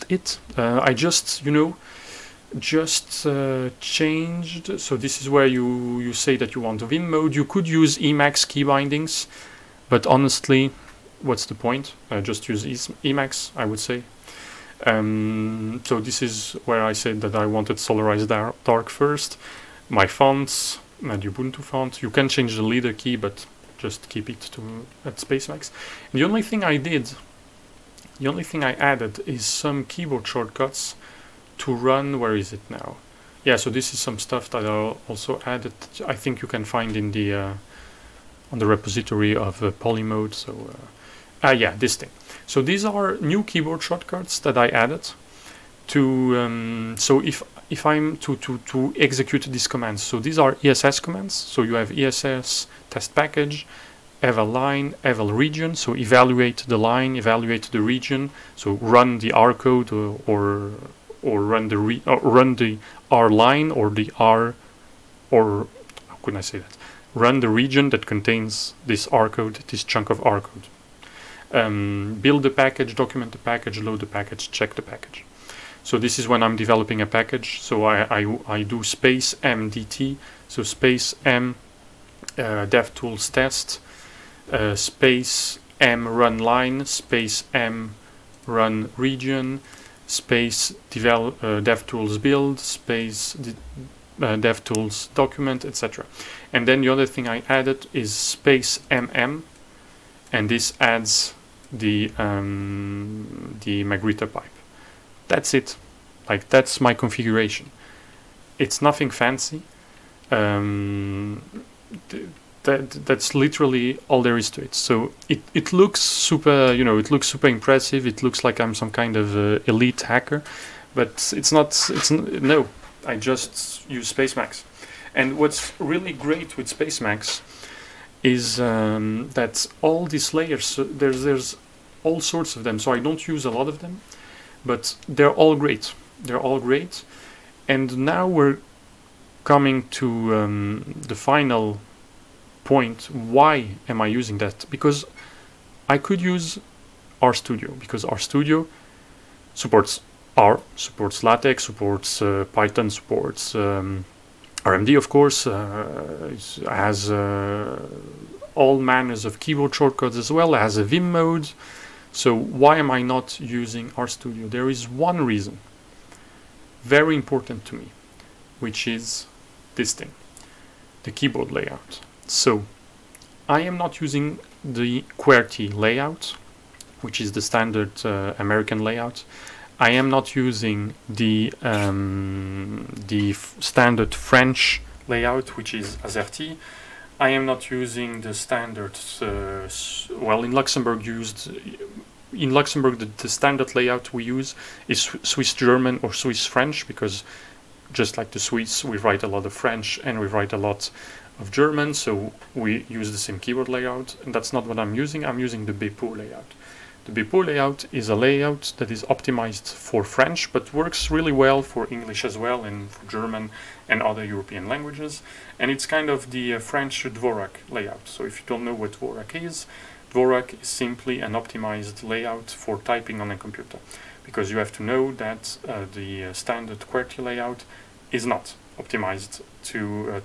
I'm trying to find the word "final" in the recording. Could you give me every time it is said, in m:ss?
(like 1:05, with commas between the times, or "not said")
2:21.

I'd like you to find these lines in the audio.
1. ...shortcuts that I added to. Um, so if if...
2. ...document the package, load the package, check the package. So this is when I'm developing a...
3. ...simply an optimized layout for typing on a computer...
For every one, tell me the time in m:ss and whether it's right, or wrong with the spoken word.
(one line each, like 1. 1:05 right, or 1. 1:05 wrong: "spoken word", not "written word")
1. 0:43 right
2. 1:12 right
3. 3:40 right.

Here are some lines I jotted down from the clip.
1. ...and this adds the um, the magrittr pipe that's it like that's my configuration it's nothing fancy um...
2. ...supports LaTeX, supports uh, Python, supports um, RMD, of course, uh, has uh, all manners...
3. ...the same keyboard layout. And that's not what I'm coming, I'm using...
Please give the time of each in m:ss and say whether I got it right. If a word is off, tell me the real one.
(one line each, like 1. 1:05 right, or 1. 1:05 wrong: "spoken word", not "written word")
1. 1:40 right
2. 2:30 right
3. 3:23 wrong: "using", not "coming".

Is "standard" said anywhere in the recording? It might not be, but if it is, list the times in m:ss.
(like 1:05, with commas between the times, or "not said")
2:57, 3:03, 3:08, 3:13, 3:46.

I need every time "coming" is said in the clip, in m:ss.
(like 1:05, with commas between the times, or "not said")
2:19.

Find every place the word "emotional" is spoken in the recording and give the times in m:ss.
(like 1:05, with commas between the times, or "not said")
not said.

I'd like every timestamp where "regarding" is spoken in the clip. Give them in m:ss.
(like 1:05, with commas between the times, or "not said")
not said.